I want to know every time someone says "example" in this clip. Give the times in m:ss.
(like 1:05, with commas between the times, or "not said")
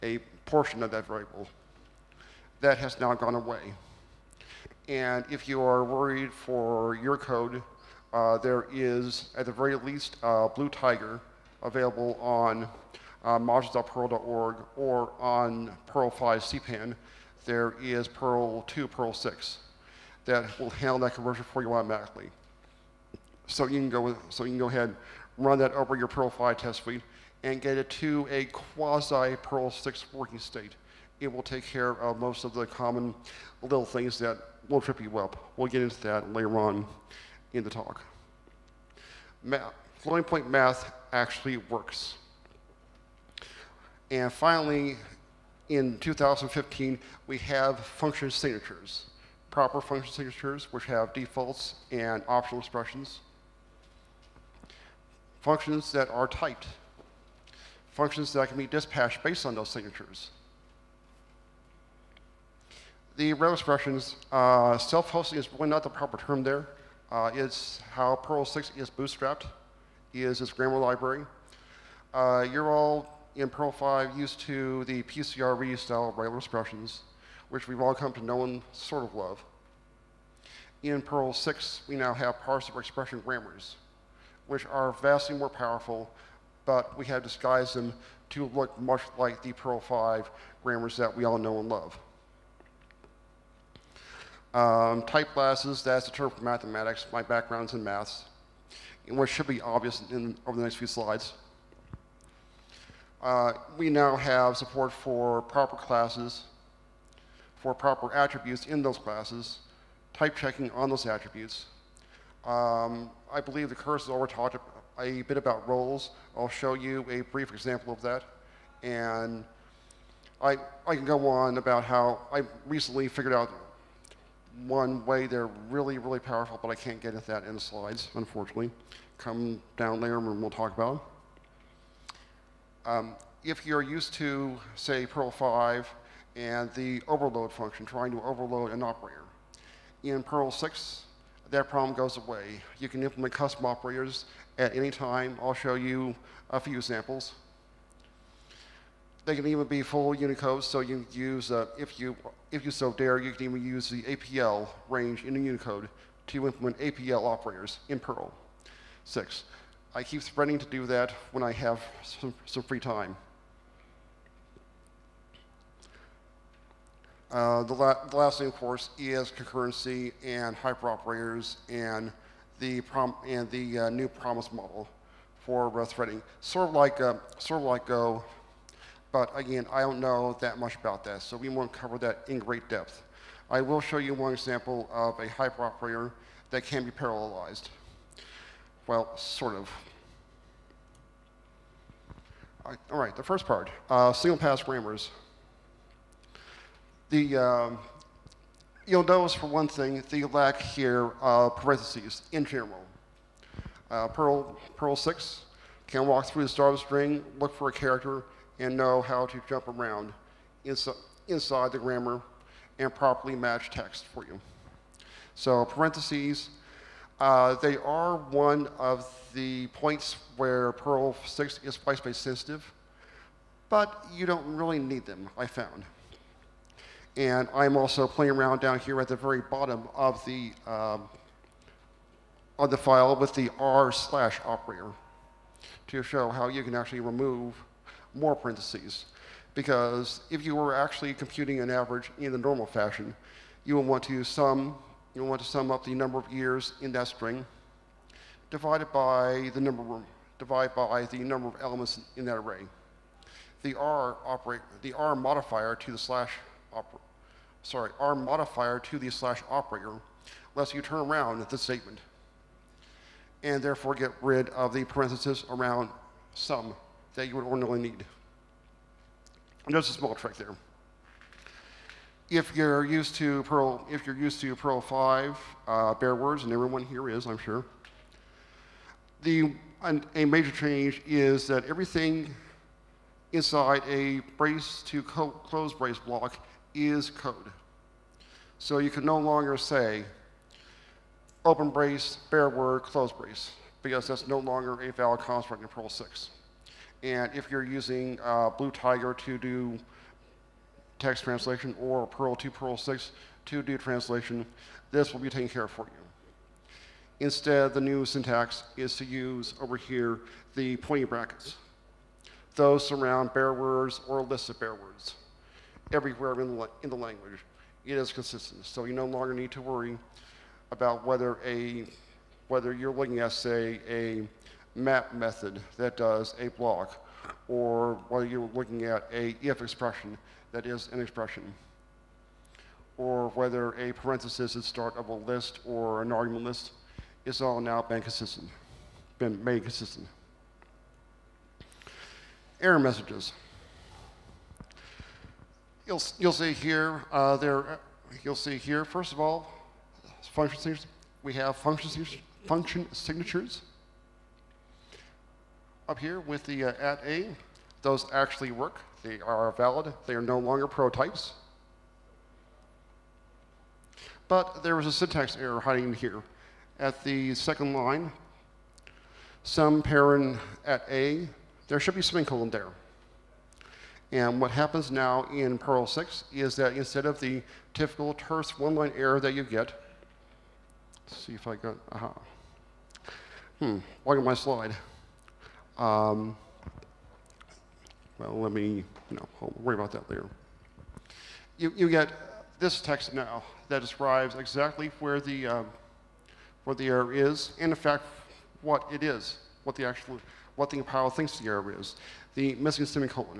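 1:57, 2:26, 3:04.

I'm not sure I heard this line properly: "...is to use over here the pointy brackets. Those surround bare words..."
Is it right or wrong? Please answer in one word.
right.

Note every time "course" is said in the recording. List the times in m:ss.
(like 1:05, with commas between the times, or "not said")
1:53, 2:48.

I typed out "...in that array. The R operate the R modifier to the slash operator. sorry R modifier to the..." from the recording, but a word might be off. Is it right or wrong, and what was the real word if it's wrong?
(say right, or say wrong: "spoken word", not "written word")
right.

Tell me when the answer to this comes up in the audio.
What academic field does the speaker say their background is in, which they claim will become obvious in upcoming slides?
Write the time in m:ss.
1:37.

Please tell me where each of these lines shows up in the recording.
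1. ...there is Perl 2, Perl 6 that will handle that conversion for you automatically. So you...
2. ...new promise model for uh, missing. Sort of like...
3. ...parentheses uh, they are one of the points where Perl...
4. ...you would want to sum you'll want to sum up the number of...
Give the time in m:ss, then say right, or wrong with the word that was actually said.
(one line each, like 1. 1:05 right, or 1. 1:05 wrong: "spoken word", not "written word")
1. 0:17 right
2. 2:53 wrong: "threading", not "missing"
3. 3:35 right
4. 4:03 right.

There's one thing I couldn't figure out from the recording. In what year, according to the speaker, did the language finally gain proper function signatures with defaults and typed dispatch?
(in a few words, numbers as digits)
2015.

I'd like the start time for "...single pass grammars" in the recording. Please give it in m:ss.
3:14.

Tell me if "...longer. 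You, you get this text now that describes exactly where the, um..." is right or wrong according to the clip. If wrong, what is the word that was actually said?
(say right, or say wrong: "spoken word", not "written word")
wrong: "later", not "longer".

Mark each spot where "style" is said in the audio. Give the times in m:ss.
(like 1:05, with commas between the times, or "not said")
1:15.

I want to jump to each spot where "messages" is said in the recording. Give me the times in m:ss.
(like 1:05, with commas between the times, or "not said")
5:42.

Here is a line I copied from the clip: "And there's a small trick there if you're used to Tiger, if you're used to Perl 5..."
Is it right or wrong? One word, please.
wrong.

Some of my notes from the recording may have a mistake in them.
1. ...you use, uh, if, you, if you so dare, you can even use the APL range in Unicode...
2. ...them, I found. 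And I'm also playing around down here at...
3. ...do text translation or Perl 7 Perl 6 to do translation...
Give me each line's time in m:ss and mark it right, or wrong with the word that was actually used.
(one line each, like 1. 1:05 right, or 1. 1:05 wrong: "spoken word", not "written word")
1. 2:30 right
2. 3:45 right
3. 4:59 wrong: "2", not "7".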